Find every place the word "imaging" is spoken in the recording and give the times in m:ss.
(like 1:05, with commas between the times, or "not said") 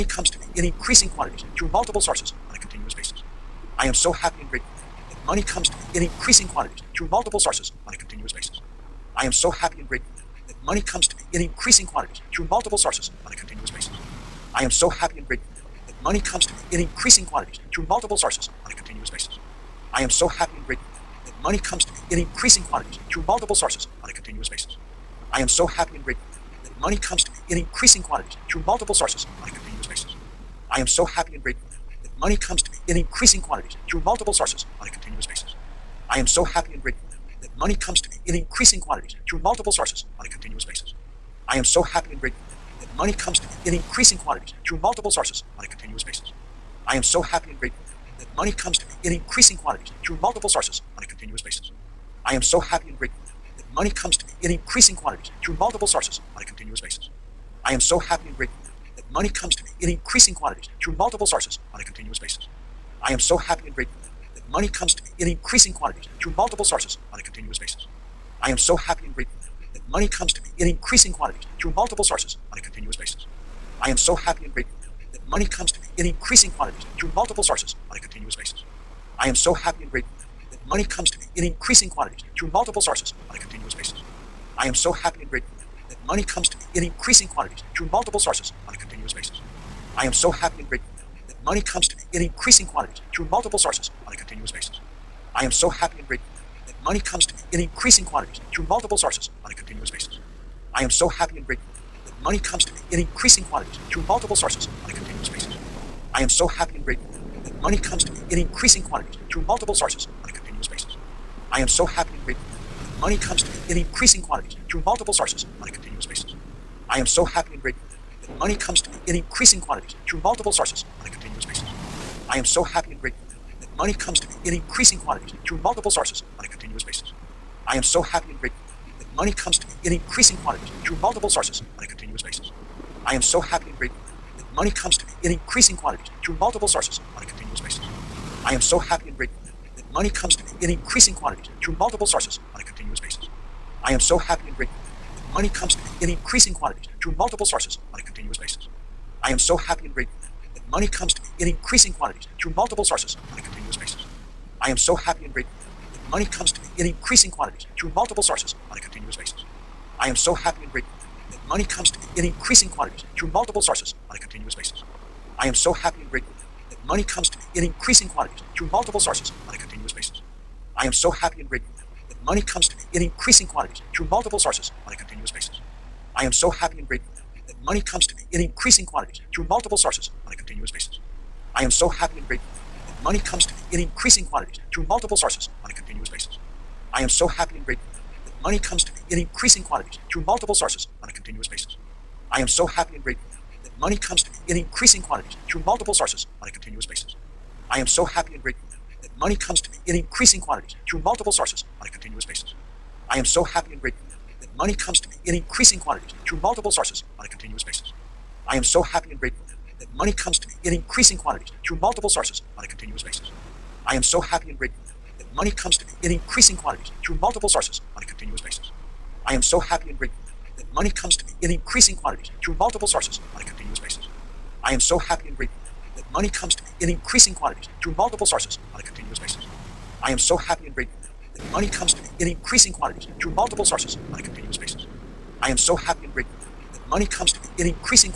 not said.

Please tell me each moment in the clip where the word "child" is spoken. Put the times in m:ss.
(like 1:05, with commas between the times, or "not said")
not said.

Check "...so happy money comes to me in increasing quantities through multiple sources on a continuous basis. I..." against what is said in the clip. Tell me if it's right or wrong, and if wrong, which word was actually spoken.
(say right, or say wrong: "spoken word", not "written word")
right.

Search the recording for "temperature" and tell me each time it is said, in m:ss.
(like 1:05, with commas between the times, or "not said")
not said.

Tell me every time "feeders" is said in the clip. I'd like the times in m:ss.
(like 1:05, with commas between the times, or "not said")
not said.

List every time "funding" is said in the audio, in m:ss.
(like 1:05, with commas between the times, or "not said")
not said.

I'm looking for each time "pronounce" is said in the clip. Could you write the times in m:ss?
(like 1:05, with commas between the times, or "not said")
not said.